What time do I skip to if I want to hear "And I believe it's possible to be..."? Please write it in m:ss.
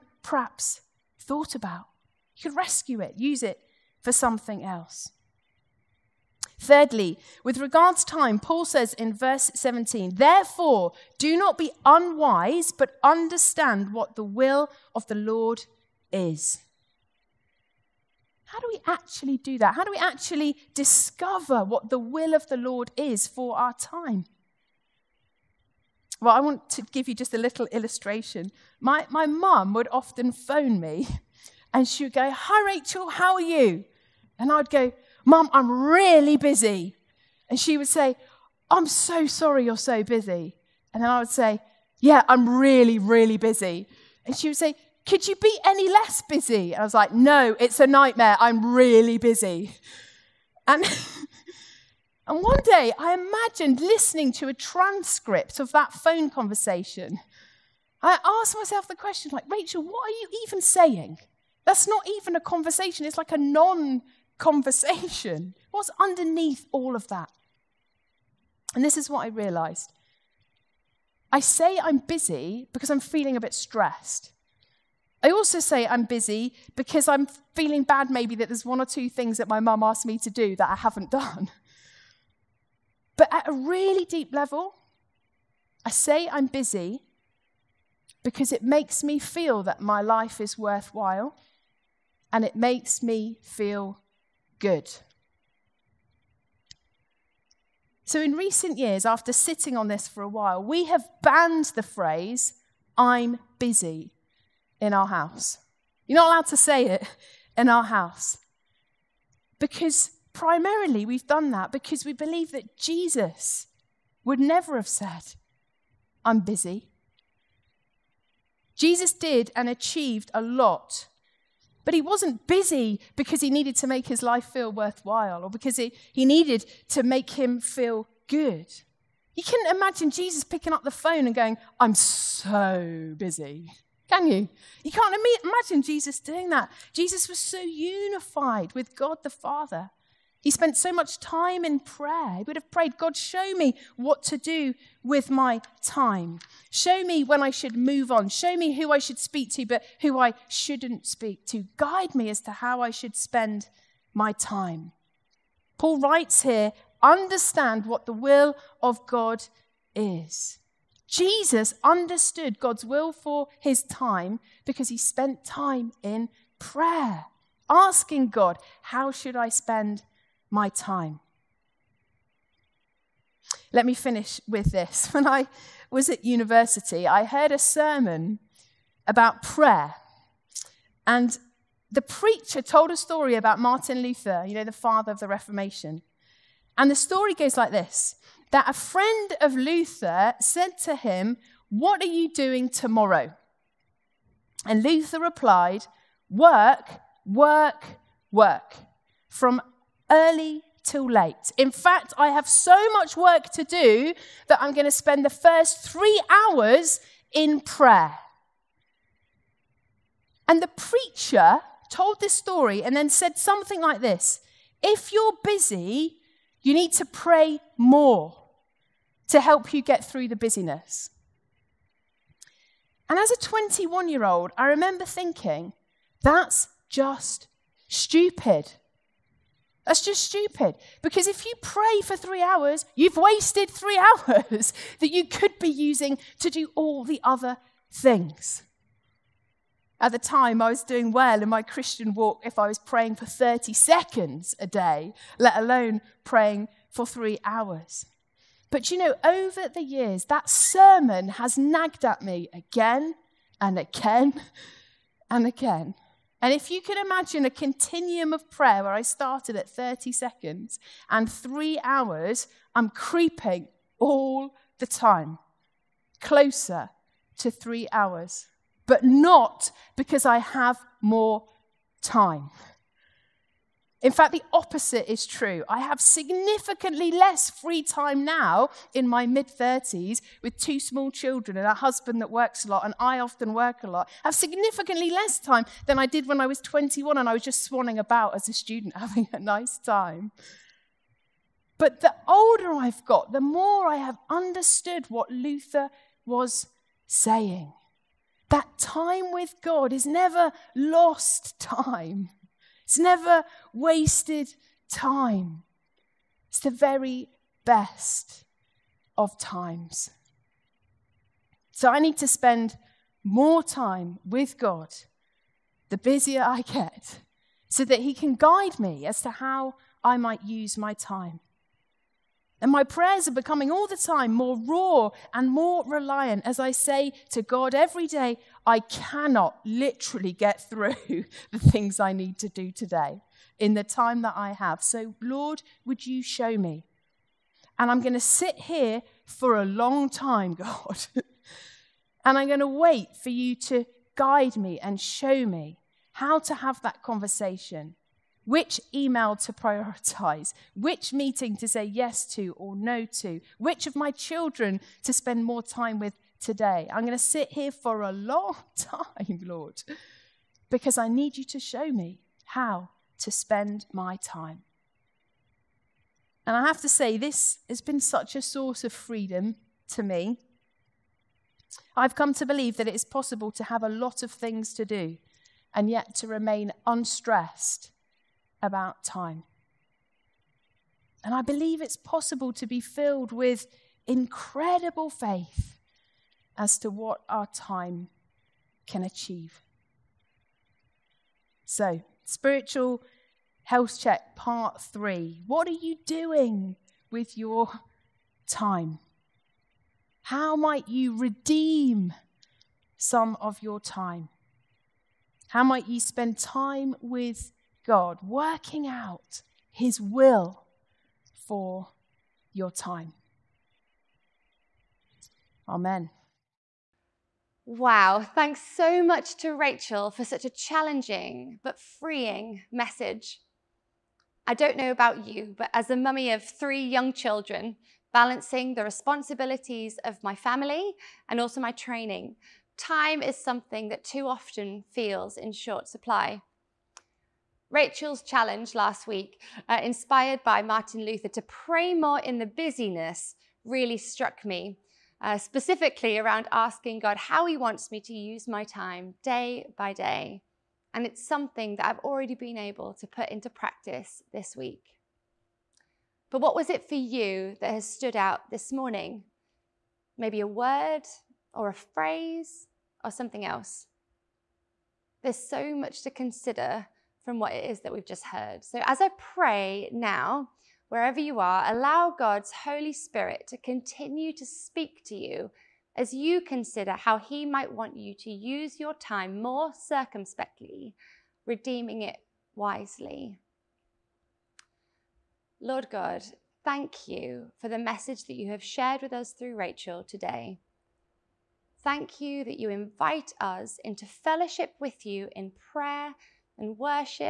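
6:21.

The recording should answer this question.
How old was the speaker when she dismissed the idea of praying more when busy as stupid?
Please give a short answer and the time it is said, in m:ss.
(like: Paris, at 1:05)
21, at 3:43.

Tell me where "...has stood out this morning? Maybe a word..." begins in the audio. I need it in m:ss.
7:37.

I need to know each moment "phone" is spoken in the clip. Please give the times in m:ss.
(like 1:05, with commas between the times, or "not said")
0:30, 0:55, 2:10.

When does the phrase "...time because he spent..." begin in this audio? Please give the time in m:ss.
2:43.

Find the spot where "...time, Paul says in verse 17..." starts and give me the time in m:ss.
0:08.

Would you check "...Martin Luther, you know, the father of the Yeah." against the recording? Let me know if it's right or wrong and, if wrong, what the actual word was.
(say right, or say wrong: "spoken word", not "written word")
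wrong: "Reformation", not "Yeah".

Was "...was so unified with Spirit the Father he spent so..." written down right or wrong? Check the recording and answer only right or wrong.
wrong.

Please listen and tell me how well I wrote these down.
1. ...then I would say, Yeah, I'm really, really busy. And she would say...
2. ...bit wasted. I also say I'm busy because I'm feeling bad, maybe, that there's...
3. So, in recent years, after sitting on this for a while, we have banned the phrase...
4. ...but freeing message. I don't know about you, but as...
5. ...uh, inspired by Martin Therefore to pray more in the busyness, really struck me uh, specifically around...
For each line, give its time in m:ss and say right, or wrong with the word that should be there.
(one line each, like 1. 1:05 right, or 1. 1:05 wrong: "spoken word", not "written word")
1. 0:41 right
2. 1:13 wrong: "stressed", not "wasted"
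3. 1:38 right
4. 7:01 right
5. 7:19 wrong: "Luther", not "Therefore".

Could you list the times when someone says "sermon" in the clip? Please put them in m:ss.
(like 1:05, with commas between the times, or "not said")
2:57, 4:10.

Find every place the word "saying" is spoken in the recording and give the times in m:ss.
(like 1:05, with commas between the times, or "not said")
1:00, 4:57.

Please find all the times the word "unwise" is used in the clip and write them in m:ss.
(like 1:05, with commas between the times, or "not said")
0:11.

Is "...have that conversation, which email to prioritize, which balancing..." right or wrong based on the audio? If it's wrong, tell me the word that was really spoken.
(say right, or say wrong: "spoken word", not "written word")
wrong: "meeting", not "balancing".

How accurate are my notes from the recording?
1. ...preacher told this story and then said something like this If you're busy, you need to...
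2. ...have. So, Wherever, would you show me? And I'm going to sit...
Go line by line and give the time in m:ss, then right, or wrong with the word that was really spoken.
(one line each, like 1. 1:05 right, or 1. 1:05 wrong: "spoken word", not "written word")
1. 3:30 right
2. 5:34 wrong: "Lord", not "Wherever".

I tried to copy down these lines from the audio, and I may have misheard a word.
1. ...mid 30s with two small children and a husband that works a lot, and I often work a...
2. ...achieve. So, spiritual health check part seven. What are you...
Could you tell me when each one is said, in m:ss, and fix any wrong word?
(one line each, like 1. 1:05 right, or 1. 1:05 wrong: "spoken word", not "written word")
1. 4:39 right
2. 6:29 wrong: "three", not "seven".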